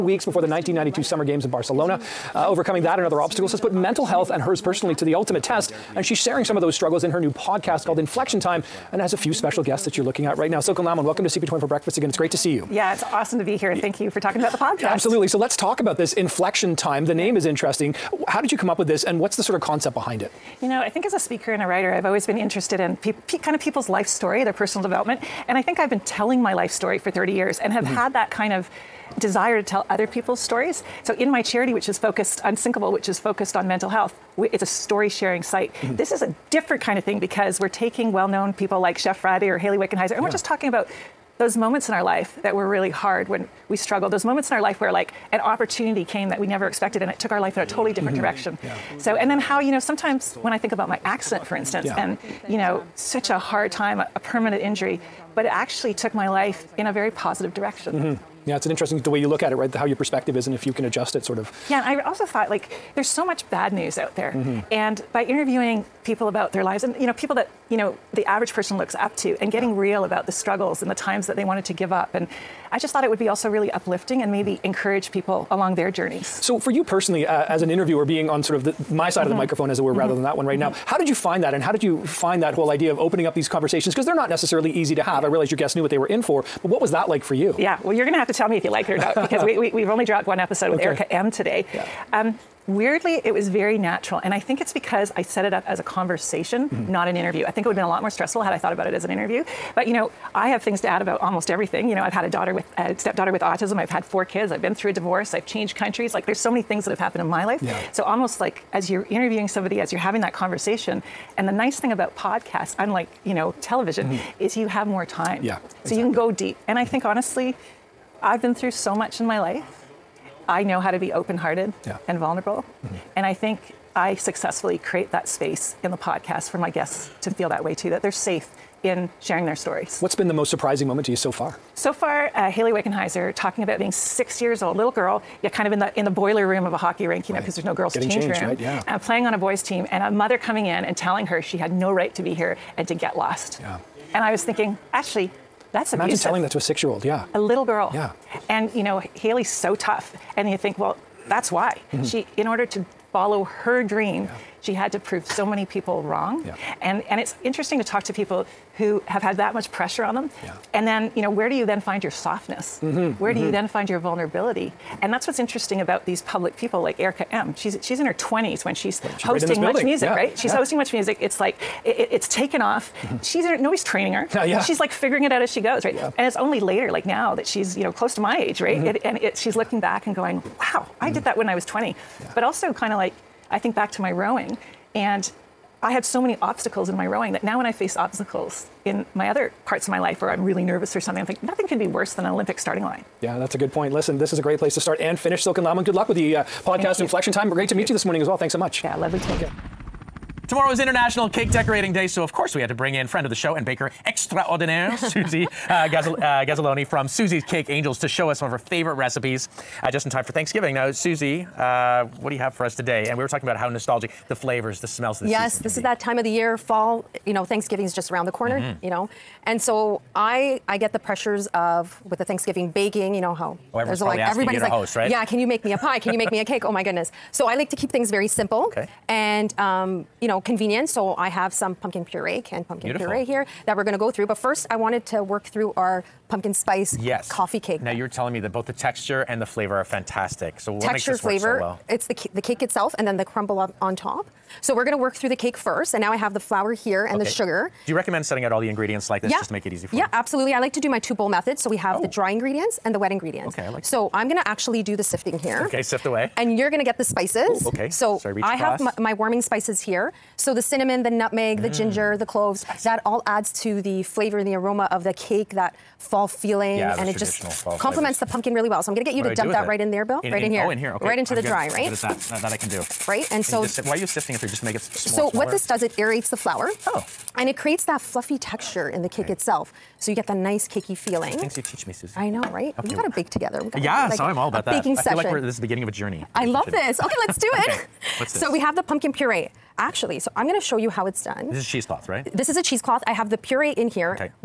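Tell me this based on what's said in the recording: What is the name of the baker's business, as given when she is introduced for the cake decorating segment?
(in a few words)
Susie's Cake Angels.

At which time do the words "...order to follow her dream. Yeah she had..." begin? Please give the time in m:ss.
2:32.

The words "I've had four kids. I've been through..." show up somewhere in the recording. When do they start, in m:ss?
1:43.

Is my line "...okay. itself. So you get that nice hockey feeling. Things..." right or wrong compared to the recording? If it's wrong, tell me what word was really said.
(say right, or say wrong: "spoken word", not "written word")
wrong: "cakey", not "hockey".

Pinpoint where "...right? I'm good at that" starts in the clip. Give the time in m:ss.
4:31.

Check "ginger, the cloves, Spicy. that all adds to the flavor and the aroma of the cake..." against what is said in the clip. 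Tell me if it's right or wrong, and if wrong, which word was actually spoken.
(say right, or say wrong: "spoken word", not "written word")
right.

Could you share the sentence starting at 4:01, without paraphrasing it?
It's the the cake itself, and then the crumble up on top.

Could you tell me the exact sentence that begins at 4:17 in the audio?
Ooh, okay, so Sorry, I across.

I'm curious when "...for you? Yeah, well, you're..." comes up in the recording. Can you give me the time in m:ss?
1:27.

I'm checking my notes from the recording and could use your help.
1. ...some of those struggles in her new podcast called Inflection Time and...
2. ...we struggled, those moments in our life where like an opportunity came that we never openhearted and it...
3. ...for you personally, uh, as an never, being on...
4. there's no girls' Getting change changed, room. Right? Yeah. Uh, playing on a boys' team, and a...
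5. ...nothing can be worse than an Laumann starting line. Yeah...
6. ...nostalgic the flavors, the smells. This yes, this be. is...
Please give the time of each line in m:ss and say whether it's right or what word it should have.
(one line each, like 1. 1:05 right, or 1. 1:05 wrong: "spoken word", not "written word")
1. 0:06 right
2. 0:43 wrong: "expected", not "openhearted"
3. 1:16 wrong: "interviewer", not "never"
4. 2:17 right
5. 3:11 wrong: "Olympic", not "Laumann"
6. 3:33 right.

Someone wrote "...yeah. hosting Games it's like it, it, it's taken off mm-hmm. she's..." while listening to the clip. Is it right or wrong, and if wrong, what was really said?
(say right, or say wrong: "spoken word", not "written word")
wrong: "MuchMusic", not "Games".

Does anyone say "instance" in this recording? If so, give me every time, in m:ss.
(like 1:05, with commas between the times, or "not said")
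0:51.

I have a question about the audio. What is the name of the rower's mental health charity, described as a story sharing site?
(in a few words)
Unsinkable.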